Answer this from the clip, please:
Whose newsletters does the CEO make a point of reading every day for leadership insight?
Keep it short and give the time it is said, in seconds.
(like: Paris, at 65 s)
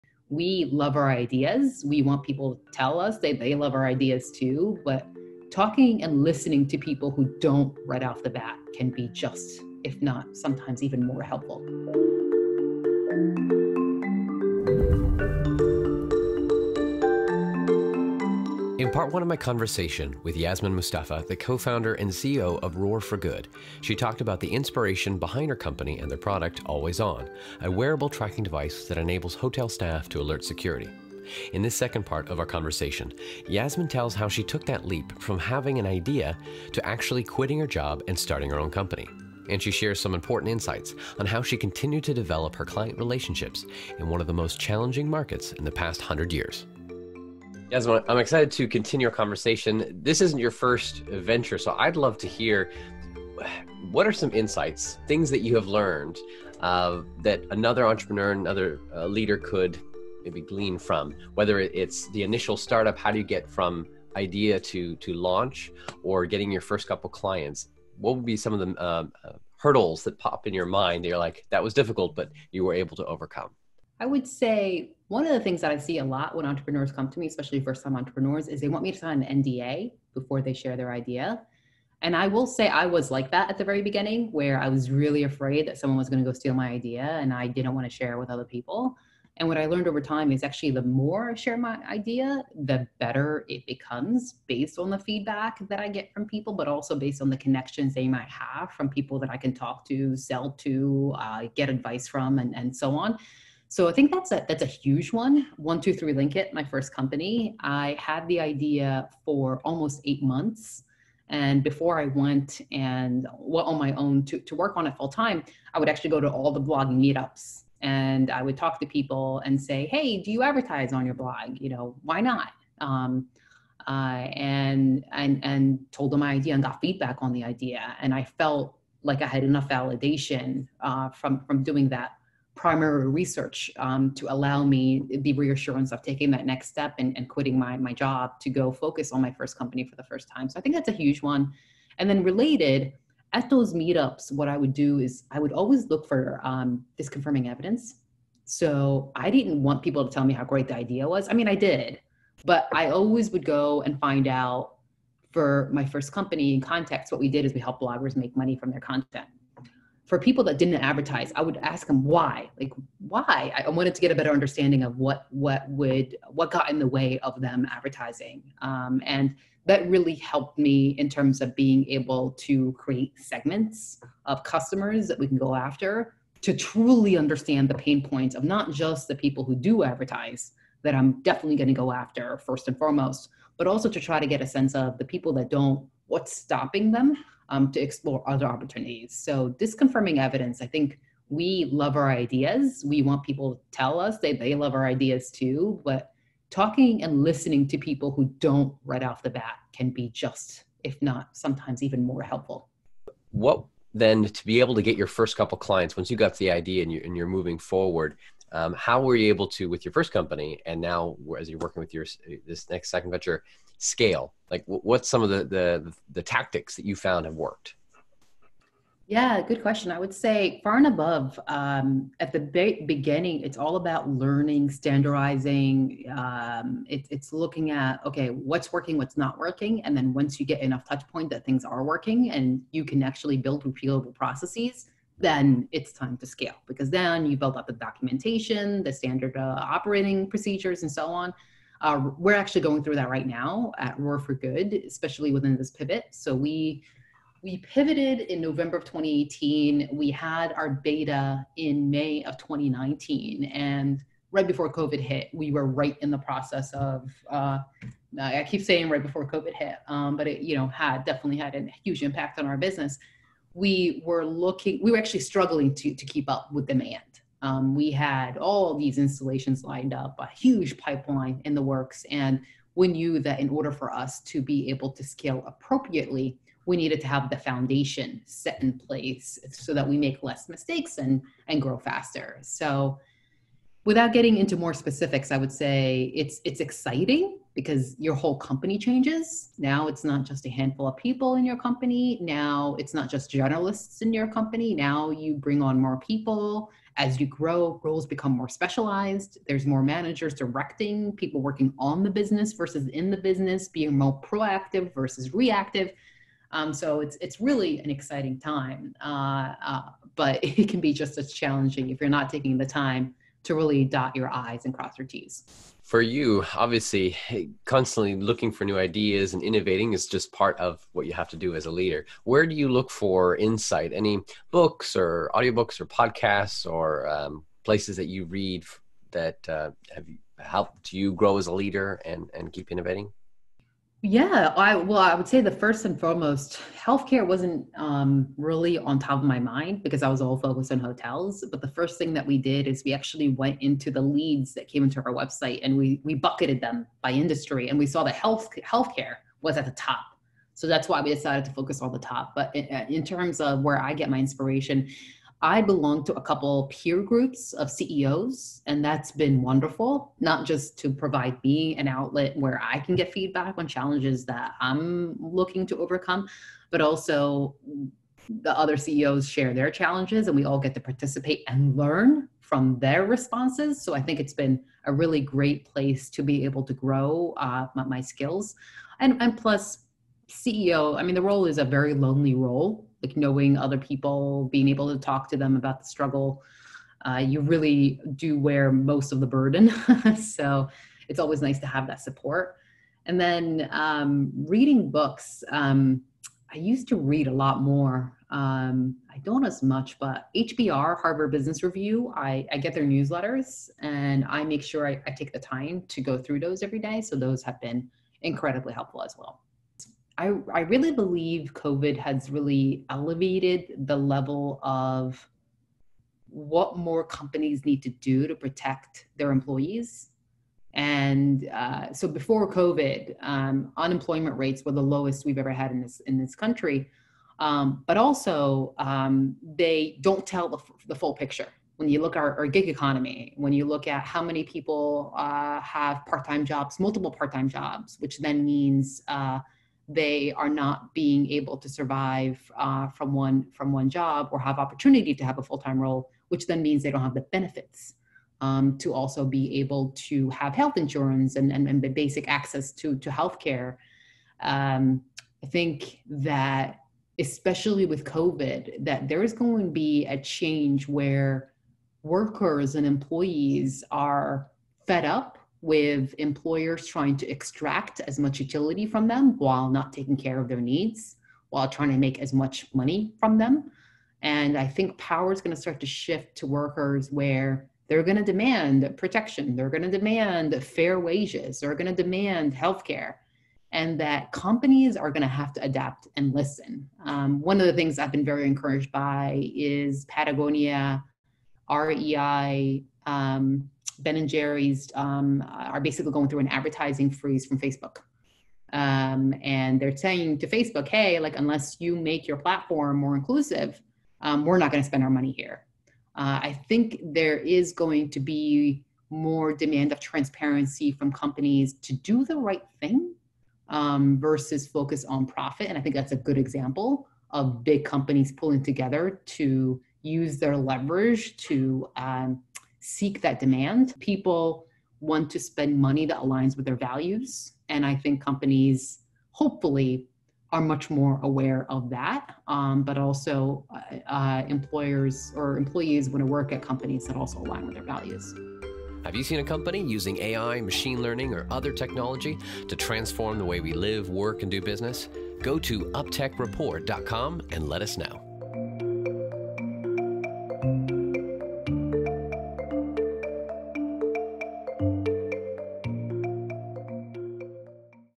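Harvard Business Review, at 401 s.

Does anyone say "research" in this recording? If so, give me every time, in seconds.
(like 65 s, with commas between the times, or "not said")
133 s.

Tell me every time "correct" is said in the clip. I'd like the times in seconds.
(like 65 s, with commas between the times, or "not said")
not said.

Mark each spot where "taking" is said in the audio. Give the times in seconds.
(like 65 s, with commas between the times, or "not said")
136 s, 312 s, 469 s.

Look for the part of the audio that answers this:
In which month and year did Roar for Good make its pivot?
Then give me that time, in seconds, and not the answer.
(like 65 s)
248 s.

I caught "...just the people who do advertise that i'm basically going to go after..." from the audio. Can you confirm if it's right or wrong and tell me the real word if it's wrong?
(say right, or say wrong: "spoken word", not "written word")
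wrong: "definitely", not "basically".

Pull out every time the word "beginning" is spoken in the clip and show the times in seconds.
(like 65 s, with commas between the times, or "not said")
83 s, 222 s.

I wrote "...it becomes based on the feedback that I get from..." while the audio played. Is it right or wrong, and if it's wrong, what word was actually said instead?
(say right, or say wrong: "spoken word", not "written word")
right.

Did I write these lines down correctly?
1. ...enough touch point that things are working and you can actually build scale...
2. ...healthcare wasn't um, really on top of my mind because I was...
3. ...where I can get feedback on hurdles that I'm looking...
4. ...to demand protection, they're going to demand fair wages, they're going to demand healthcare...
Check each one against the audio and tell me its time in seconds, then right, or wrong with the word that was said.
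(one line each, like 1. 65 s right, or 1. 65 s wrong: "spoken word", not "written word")
1. 230 s wrong: "repeatable", not "scale"
2. 336 s right
3. 362 s wrong: "challenges", not "hurdles"
4. 478 s right.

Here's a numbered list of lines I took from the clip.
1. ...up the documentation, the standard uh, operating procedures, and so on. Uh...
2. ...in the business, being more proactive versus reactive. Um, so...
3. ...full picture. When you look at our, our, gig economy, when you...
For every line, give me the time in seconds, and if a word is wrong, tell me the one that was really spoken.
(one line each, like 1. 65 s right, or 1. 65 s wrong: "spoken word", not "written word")
1. 237 s right
2. 302 s right
3. 430 s right.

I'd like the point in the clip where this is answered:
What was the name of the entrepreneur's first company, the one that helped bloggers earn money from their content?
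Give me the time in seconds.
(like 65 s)
105 s.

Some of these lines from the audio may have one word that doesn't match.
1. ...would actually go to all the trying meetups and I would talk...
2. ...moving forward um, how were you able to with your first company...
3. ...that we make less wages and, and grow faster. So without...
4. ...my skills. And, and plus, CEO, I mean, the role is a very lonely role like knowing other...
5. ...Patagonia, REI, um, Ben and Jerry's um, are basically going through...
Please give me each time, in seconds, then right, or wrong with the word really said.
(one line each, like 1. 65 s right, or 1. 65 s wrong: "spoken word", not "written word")
1. 115 s wrong: "blogging", not "trying"
2. 207 s right
3. 279 s wrong: "mistakes", not "wages"
4. 377 s right
5. 490 s right.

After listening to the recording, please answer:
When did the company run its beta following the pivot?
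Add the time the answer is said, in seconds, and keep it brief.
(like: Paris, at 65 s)
May 2019, at 251 s.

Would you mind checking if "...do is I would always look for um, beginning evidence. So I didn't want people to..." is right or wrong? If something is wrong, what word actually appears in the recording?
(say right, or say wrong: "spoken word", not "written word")
wrong: "disconfirming", not "beginning".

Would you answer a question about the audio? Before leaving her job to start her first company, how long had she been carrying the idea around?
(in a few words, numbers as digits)
Almost eight months.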